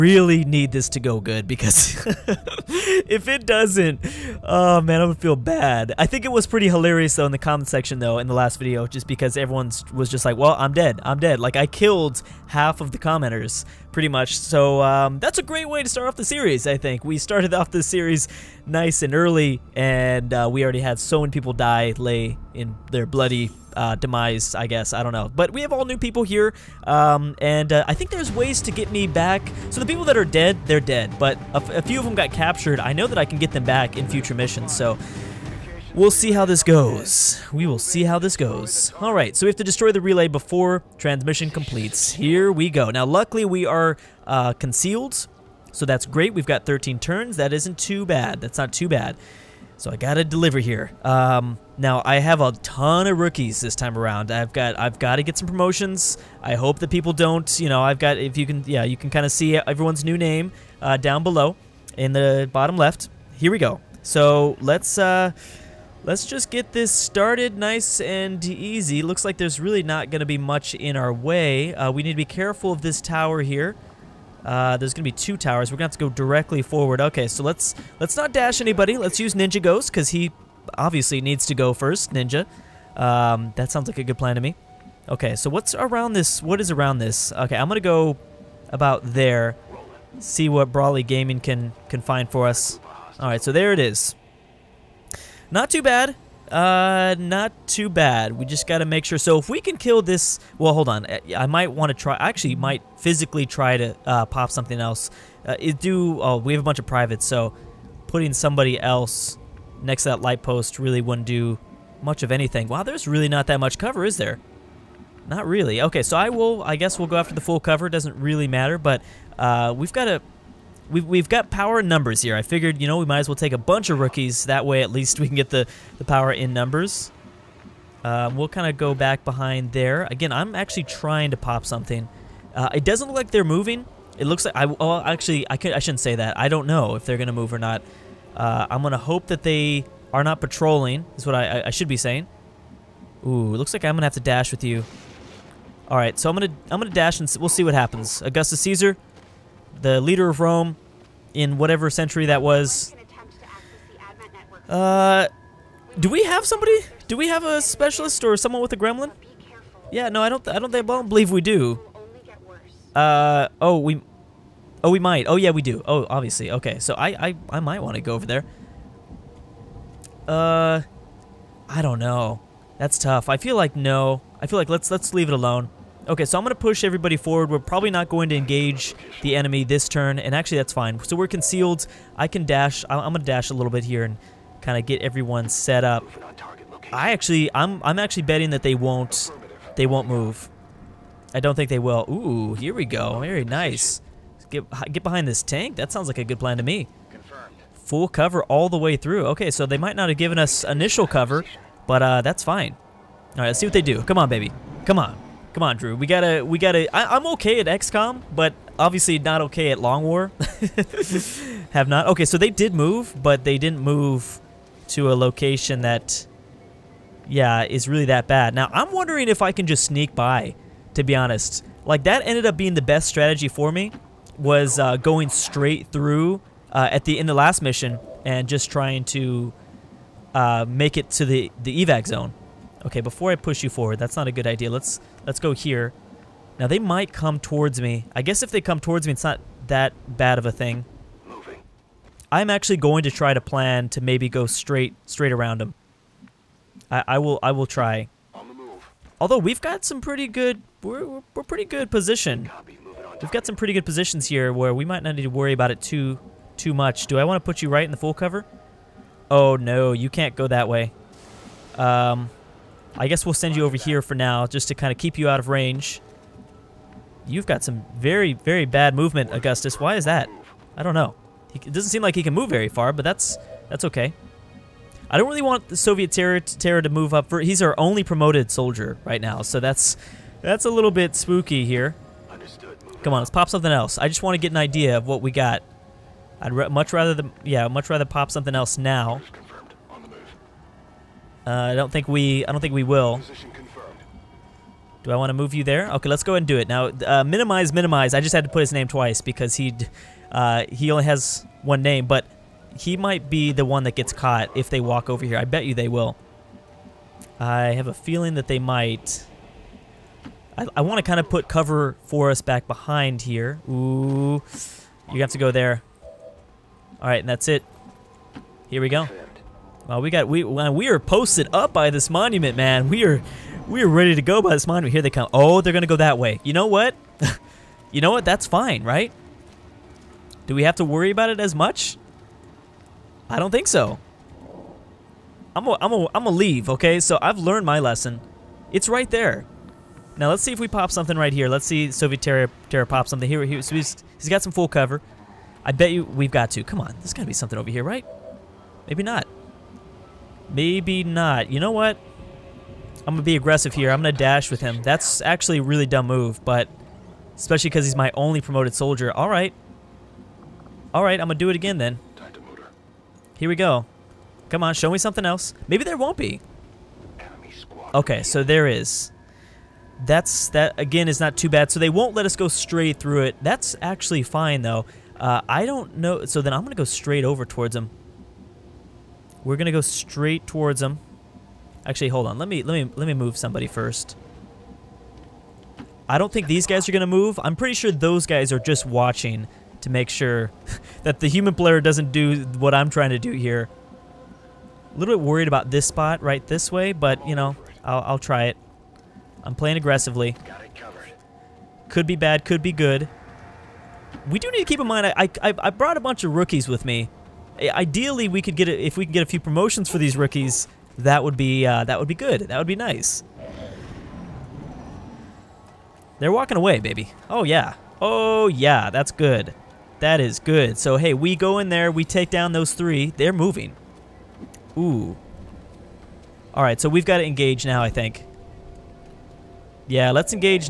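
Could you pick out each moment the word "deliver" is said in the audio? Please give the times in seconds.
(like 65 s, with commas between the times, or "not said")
50 s.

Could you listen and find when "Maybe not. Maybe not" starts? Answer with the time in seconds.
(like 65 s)
348 s.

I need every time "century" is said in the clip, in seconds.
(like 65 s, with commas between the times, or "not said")
151 s.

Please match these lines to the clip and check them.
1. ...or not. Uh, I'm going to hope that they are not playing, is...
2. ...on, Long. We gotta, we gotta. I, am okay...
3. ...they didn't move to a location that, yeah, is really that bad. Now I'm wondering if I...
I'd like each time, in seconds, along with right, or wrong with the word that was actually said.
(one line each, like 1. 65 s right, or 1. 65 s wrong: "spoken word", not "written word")
1. 137 s wrong: "patrolling", not "playing"
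2. 205 s wrong: "Drew", not "Long"
3. 213 s right.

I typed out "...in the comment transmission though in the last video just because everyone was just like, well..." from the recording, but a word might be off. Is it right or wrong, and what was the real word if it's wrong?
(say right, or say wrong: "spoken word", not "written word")
wrong: "section", not "transmission".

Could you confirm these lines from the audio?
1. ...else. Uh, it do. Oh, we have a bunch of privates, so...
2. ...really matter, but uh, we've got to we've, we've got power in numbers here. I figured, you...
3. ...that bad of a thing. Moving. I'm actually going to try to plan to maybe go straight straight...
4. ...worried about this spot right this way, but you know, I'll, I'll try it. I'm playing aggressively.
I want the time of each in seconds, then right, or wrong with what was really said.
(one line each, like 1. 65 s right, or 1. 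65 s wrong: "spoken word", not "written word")
1. 104 s right
2. 118 s right
3. 239 s right
4. 395 s right.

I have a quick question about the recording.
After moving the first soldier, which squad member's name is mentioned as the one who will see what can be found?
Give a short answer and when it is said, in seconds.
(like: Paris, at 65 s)
Brawly Gaming, at 90 s.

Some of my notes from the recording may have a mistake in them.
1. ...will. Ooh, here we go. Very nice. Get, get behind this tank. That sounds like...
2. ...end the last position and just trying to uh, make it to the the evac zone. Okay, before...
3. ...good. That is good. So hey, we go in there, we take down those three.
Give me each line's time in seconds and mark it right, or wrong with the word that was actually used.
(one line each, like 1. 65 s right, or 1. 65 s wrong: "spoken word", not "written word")
1. 191 s right
2. 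227 s wrong: "mission", not "position"
3. 419 s right.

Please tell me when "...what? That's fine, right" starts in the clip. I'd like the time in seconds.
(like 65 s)
328 s.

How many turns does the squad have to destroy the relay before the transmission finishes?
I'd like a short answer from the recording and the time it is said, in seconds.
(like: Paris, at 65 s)
13, at 46 s.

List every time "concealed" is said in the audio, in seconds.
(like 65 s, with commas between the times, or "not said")
44 s, 181 s.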